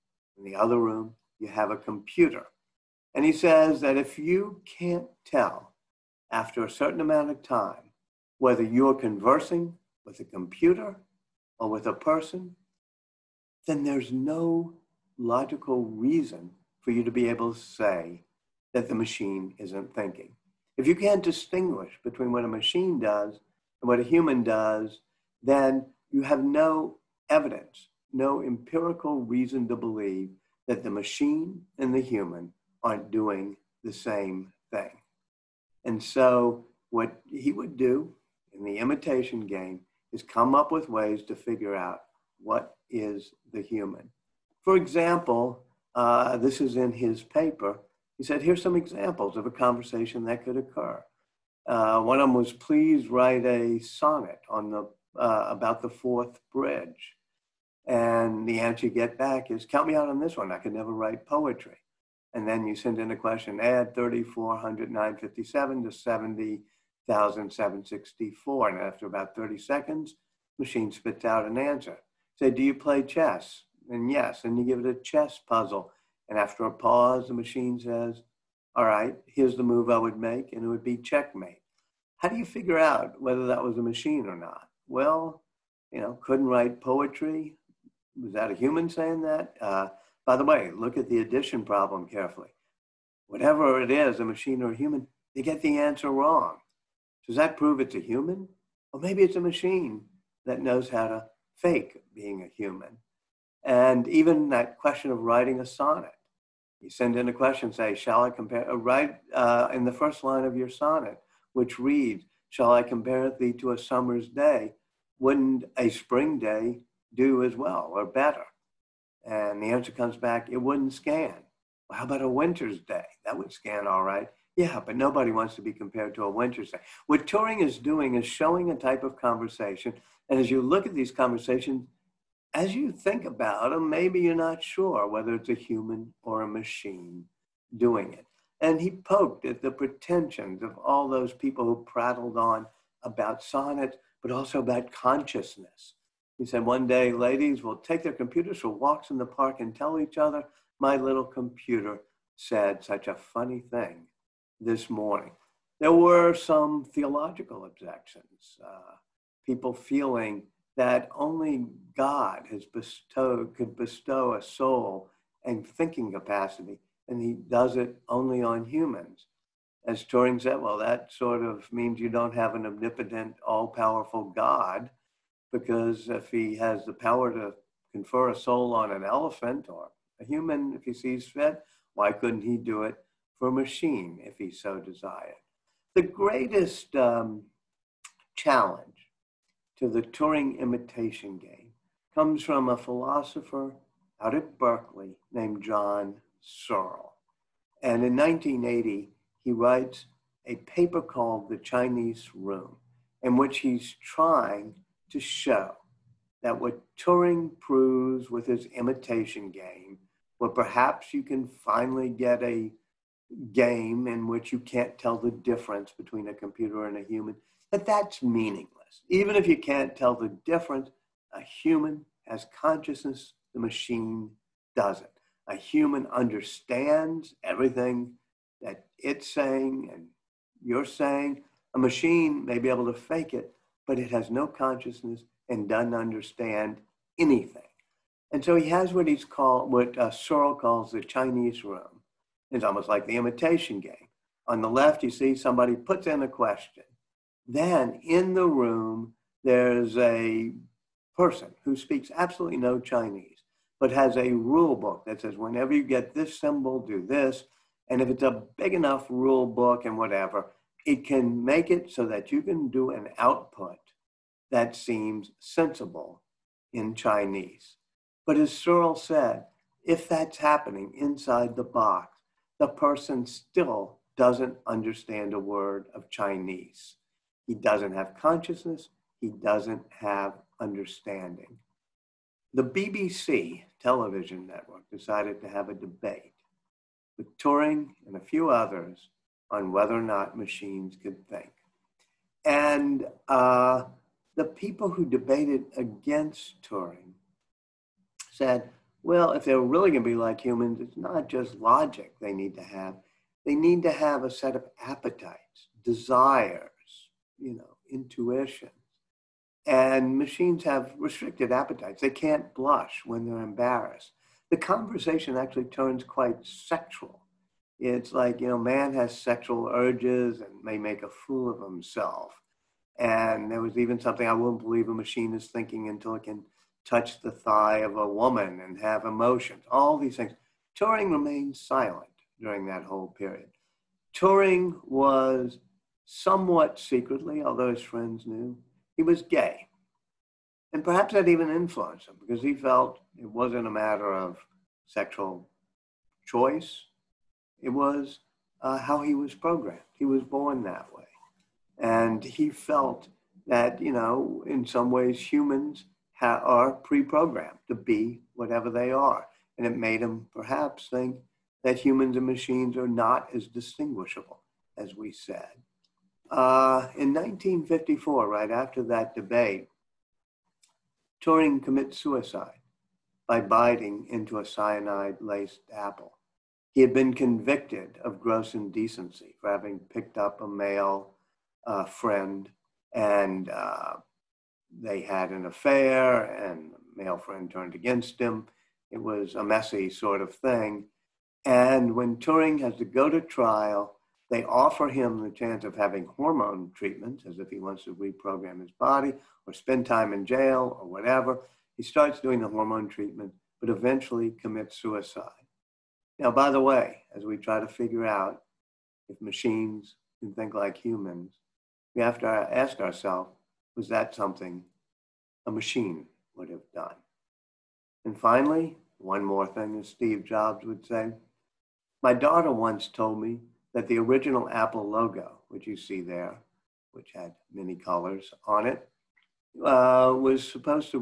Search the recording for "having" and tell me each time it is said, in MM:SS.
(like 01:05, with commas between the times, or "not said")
06:19, 06:35.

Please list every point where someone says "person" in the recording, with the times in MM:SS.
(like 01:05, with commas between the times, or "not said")
00:11, 04:11, 04:32.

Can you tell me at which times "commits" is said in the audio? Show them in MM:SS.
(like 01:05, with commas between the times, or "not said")
06:11, 06:44.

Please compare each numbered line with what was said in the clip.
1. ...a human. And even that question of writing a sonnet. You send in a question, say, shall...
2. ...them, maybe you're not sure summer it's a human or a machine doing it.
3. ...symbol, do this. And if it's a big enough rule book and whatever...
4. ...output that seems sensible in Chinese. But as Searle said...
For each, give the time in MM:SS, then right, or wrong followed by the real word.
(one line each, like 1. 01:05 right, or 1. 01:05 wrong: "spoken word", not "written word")
1. 01:42 right
2. 02:13 wrong: "whether", not "summer"
3. 04:16 right
4. 04:23 right.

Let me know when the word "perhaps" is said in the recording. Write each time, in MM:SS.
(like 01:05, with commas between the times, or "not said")
03:30, 05:40, 06:00.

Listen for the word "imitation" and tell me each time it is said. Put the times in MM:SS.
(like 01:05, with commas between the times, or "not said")
00:38, 03:10, 03:28, 04:03.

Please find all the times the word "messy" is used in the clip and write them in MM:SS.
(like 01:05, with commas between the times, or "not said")
06:29.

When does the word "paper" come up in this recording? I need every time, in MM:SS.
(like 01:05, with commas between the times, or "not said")
00:47, 03:20.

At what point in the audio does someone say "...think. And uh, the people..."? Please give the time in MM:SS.
04:51.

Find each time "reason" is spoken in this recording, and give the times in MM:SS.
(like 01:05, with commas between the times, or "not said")
00:15, 00:29.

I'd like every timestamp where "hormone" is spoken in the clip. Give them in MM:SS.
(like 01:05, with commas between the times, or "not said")
06:36, 06:42.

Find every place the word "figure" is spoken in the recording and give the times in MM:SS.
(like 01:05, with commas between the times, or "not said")
00:41, 01:22, 06:47.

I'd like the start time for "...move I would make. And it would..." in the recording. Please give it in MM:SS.
01:19.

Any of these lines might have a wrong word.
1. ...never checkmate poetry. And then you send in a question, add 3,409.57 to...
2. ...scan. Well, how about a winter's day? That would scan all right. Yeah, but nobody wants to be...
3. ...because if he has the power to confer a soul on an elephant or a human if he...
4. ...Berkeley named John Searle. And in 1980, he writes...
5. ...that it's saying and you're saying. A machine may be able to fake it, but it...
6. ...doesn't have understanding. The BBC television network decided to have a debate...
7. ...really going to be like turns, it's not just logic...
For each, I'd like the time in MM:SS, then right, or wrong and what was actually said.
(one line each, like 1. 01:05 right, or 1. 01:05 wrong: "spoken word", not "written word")
1. 01:00 wrong: "write", not "checkmate"
2. 02:00 right
3. 02:55 right
4. 03:14 right
5. 03:48 right
6. 04:39 right
7. 04:59 wrong: "humans", not "turns".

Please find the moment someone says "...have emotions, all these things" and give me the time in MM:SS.
05:28.